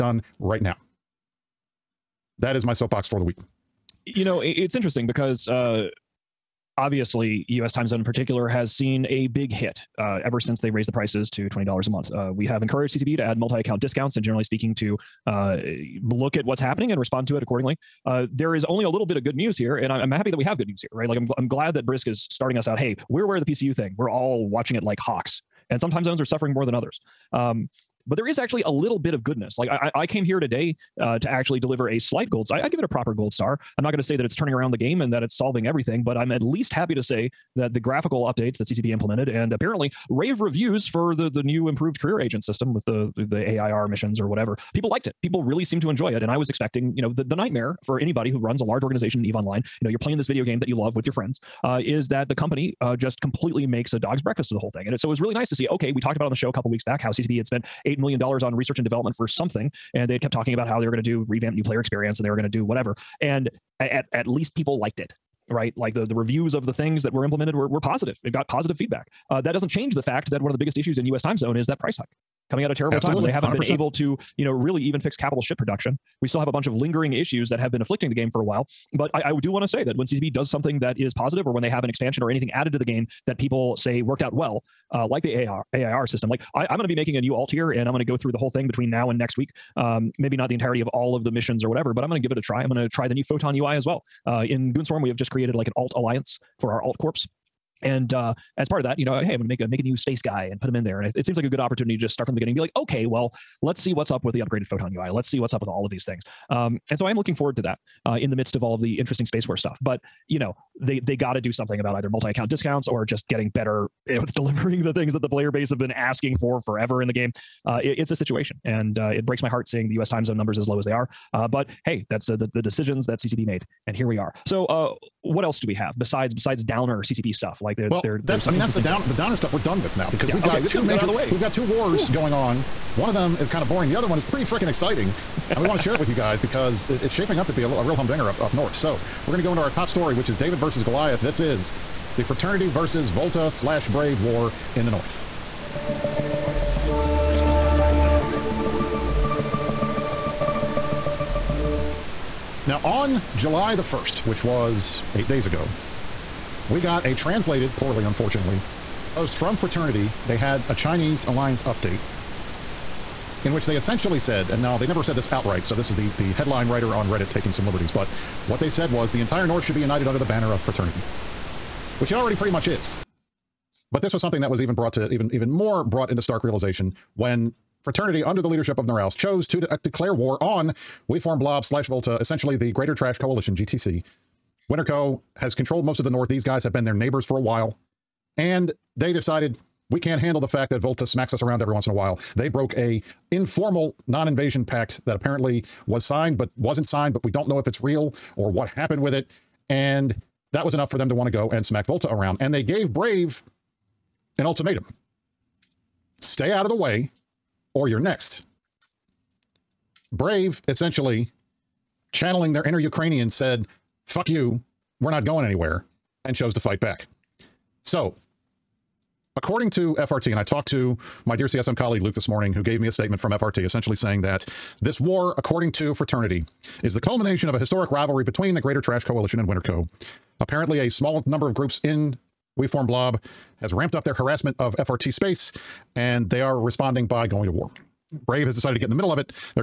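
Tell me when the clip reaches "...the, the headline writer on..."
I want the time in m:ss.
2:45.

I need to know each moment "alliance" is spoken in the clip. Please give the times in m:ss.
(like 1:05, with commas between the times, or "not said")
1:35, 2:41.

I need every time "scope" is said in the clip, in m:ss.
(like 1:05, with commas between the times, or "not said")
not said.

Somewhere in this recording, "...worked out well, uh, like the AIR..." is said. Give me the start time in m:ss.
1:24.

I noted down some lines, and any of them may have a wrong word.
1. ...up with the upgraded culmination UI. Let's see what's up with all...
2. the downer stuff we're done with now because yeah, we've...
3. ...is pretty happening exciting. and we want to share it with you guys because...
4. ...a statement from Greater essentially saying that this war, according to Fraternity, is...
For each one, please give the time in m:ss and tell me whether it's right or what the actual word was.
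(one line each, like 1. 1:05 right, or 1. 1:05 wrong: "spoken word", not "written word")
1. 1:44 wrong: "photon", not "culmination"
2. 2:09 right
3. 2:14 wrong: "freaking", not "happening"
4. 3:42 wrong: "FRT", not "Greater".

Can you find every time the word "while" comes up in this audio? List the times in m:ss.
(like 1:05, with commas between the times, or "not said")
1:18, 3:07, 3:11.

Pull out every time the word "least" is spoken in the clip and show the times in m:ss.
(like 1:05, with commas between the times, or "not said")
0:36, 1:04.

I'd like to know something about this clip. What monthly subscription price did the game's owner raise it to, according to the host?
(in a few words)
$20.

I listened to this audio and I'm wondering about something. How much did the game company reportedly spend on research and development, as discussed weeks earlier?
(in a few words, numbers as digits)
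$8 million.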